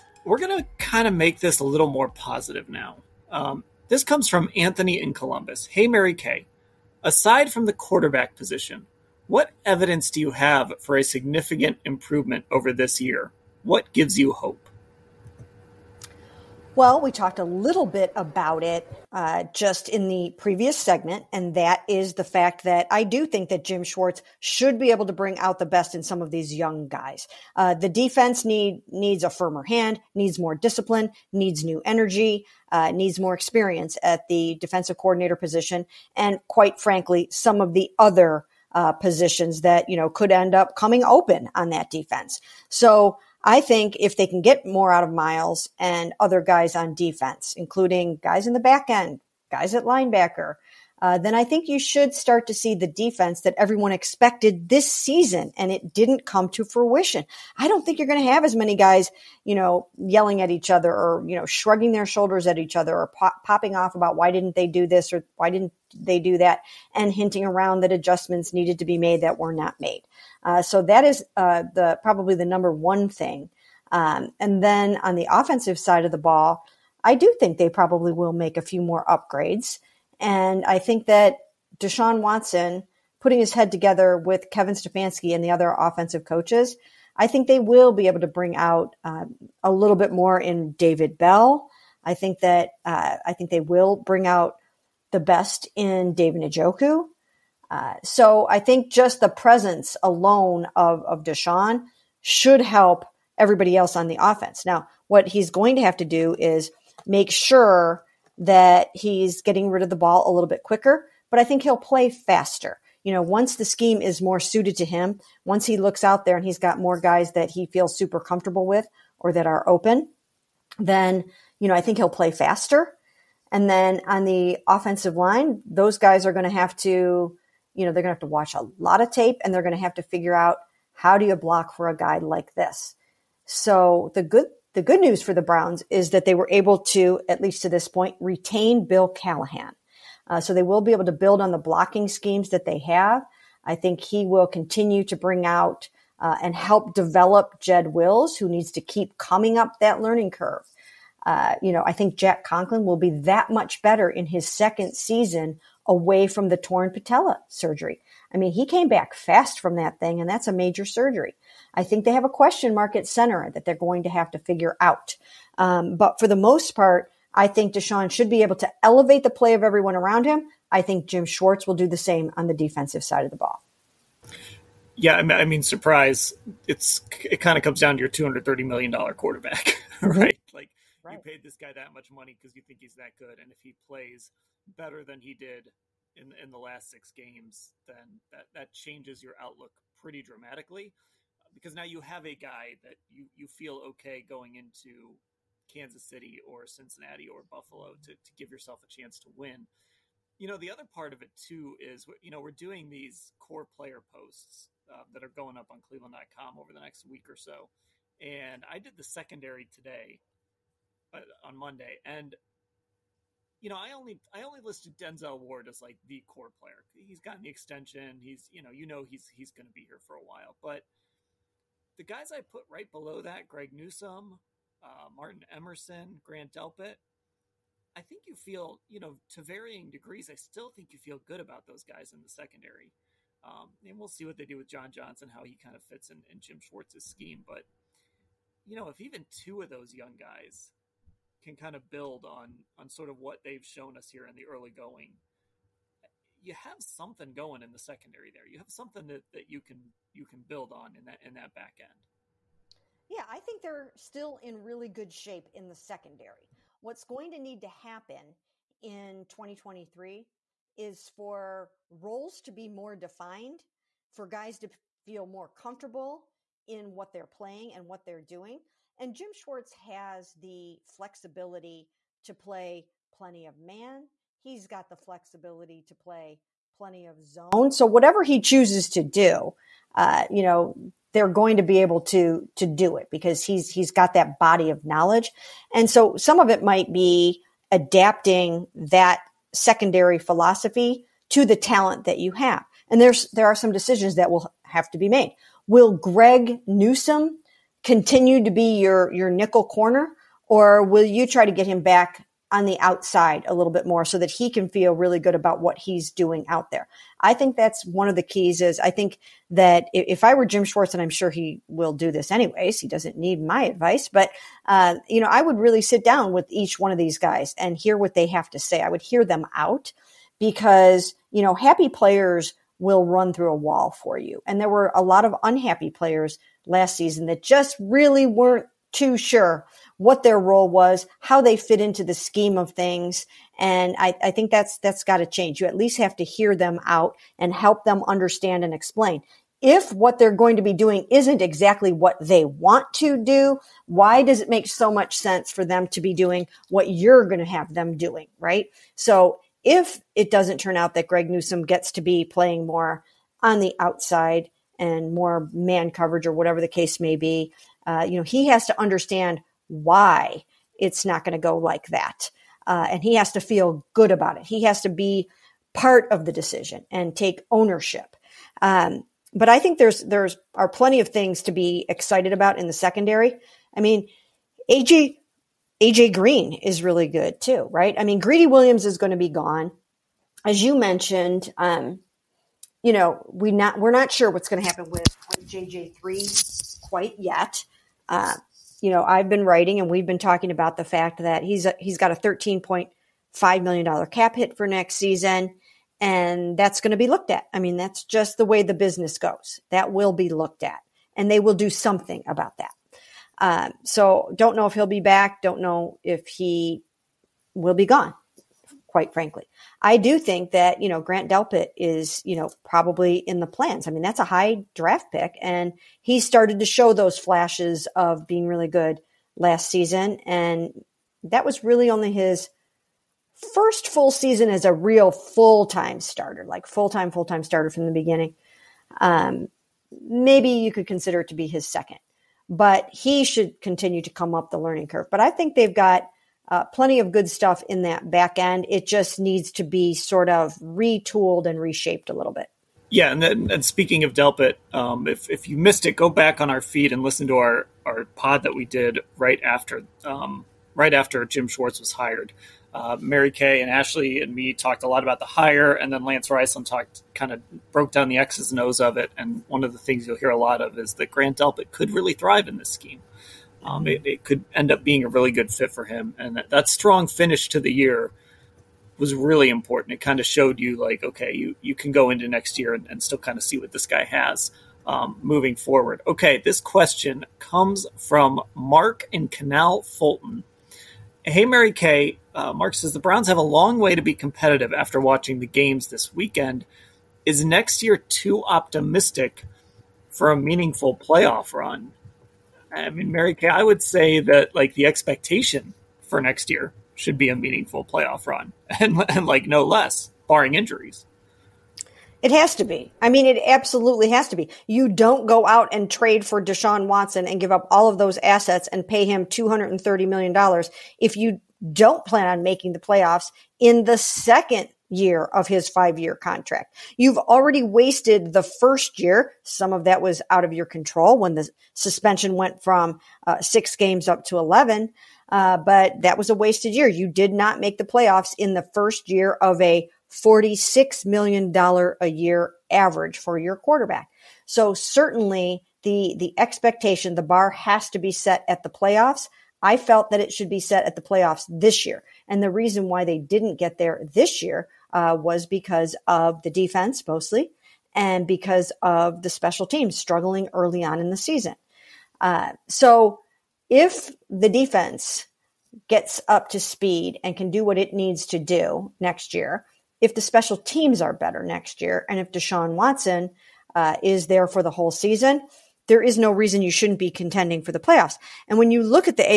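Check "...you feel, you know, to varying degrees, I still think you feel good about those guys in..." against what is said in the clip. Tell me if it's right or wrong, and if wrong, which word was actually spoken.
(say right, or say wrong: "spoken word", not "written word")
right.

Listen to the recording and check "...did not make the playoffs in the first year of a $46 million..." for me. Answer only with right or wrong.
right.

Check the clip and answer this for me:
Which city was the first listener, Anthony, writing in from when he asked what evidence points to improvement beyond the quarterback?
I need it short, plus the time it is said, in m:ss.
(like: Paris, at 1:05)
Columbus, at 0:05.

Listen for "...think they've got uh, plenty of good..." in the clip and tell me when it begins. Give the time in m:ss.
7:15.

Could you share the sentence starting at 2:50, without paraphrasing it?
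I think Jim Schwartz will do the same on the defensive side of the ball.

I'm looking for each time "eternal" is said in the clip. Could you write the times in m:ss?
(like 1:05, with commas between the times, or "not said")
not said.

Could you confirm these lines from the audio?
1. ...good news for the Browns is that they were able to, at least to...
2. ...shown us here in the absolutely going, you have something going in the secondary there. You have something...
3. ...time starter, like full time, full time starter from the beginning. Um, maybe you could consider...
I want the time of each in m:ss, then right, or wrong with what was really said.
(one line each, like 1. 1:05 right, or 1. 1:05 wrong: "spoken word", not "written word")
1. 2:14 right
2. 4:03 wrong: "early", not "absolutely"
3. 7:05 right.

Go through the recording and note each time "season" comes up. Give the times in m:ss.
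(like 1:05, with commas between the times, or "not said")
0:54, 2:34, 5:26, 6:34, 6:59, 7:04, 9:11, 9:24.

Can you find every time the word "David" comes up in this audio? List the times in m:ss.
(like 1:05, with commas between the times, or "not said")
1:30, 1:36.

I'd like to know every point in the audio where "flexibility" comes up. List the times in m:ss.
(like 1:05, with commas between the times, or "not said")
4:30, 4:34.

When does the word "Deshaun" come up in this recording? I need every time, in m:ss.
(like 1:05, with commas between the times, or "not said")
1:21, 1:41, 2:47, 8:26, 9:22.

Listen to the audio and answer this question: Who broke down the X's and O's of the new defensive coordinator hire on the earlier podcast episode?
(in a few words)
Lance Reisland.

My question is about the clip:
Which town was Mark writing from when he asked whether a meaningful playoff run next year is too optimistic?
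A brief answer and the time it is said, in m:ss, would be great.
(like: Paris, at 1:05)
Canal Fulton, at 7:59.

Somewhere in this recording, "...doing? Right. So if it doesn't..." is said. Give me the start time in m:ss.
5:47.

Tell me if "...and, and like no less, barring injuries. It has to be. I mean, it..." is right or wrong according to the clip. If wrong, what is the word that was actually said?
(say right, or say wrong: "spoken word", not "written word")
right.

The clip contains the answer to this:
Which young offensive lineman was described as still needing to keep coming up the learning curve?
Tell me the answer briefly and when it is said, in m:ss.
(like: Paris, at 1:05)
Jed Wills, at 2:27.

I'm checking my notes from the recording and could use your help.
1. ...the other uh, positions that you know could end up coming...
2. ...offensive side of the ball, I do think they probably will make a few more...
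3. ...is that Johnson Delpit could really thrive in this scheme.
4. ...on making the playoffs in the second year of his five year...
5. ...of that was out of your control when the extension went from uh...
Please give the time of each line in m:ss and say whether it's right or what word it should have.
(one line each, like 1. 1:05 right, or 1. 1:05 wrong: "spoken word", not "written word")
1. 0:37 right
2. 1:15 right
3. 7:40 wrong: "Grant", not "Johnson"
4. 8:32 right
5. 8:39 wrong: "suspension", not "extension".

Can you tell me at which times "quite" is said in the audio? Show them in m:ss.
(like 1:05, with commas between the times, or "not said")
0:36, 6:26, 6:48.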